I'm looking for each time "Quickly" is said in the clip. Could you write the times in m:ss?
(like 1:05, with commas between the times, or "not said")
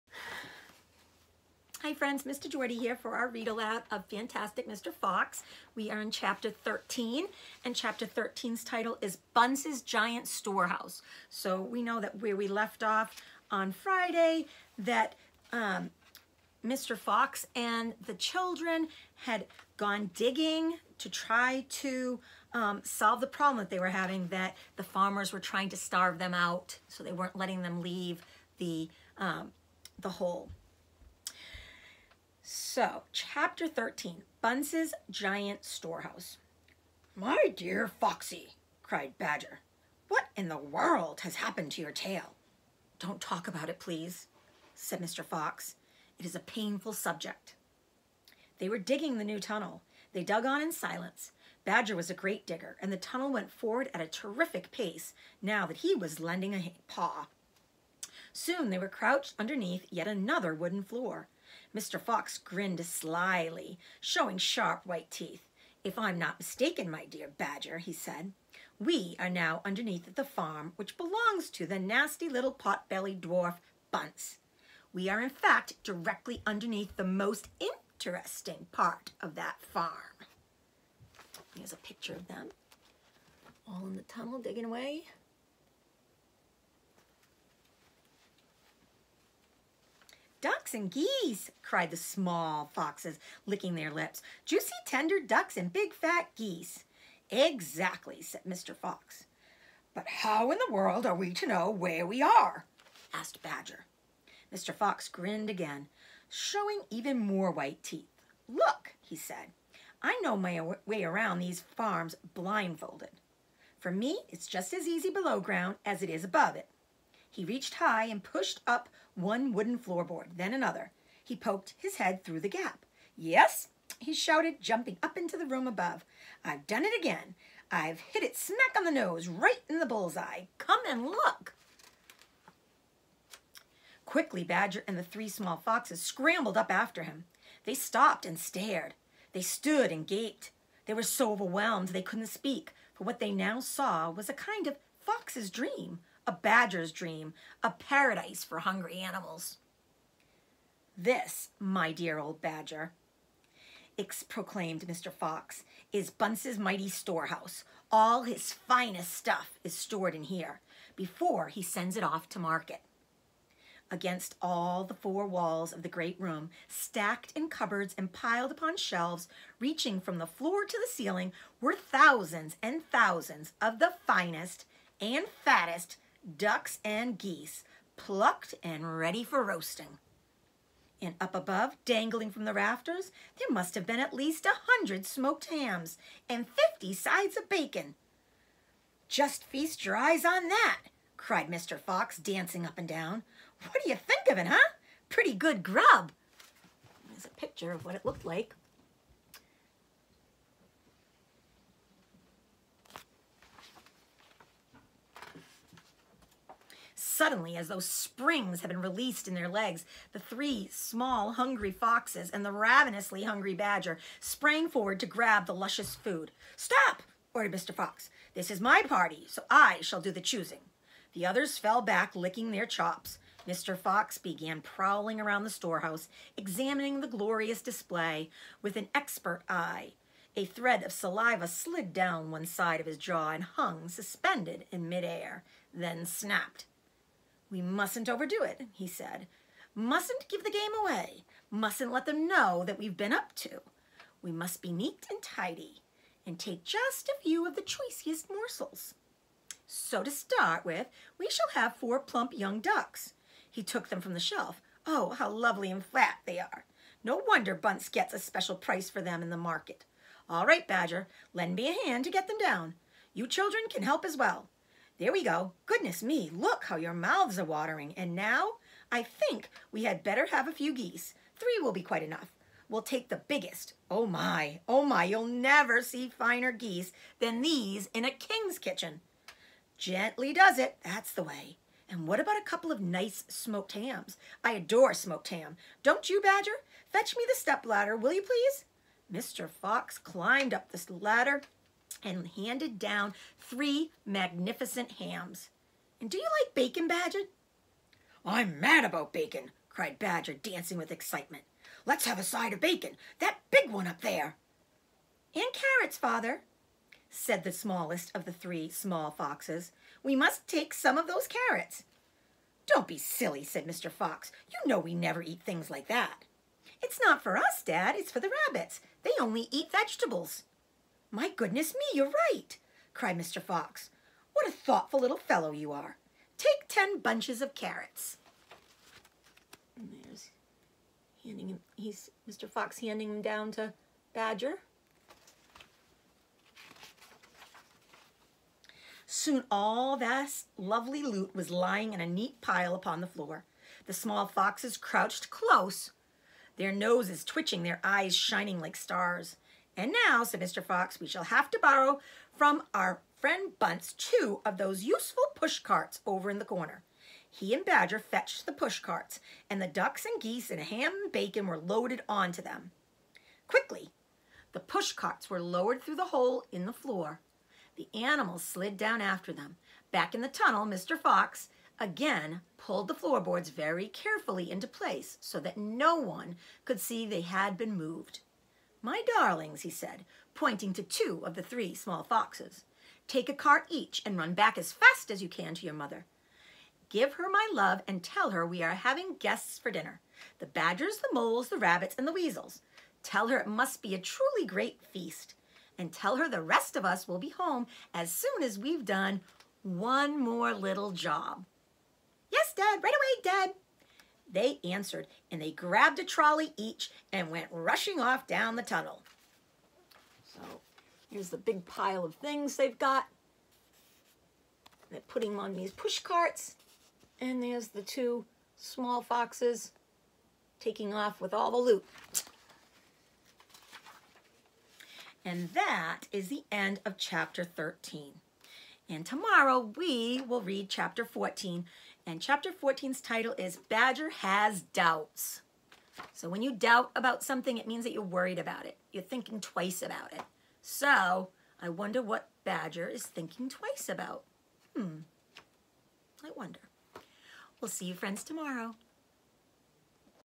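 2:14, 6:03.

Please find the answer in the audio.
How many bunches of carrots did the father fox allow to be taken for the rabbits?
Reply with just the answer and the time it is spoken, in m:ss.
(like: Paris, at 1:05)
10, at 5:26.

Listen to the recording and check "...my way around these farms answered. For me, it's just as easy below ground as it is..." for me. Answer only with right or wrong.
wrong.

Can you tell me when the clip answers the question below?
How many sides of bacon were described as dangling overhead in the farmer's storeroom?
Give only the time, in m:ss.
3:06.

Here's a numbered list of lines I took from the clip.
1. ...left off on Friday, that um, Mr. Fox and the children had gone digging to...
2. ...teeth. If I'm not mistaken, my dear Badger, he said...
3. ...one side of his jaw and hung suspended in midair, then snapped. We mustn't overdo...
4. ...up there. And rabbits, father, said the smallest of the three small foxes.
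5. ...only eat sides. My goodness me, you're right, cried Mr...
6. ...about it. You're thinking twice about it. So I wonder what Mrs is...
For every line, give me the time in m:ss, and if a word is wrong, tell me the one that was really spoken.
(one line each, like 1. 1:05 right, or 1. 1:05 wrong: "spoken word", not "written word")
1. 0:12 right
2. 1:05 right
3. 3:52 right
4. 5:03 wrong: "carrots", not "rabbits"
5. 5:19 wrong: "vegetables", not "sides"
6. 7:18 wrong: "Badger", not "Mrs".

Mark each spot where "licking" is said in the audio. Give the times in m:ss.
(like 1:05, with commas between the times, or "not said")
1:33, 3:42.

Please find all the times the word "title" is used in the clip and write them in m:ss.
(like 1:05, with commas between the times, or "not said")
0:08, 7:13.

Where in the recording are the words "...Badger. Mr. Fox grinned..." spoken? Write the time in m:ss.
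1:43.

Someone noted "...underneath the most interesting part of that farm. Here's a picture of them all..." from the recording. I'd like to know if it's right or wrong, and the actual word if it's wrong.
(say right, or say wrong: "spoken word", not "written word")
right.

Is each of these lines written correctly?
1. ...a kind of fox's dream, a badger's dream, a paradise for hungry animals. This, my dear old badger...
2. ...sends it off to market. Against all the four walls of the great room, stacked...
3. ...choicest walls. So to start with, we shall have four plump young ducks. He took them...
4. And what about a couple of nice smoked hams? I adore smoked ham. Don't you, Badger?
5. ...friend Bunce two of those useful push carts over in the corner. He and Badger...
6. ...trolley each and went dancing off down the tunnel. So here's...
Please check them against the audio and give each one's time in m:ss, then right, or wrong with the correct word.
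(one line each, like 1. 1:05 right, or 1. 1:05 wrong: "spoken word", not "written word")
1. 2:24 right
2. 2:41 right
3. 4:07 wrong: "morsels", not "walls"
4. 4:41 right
5. 5:53 right
6. 6:46 wrong: "rushing", not "dancing".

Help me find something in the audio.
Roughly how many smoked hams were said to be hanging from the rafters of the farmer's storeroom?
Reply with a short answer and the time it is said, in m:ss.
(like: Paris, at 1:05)
100, at 3:04.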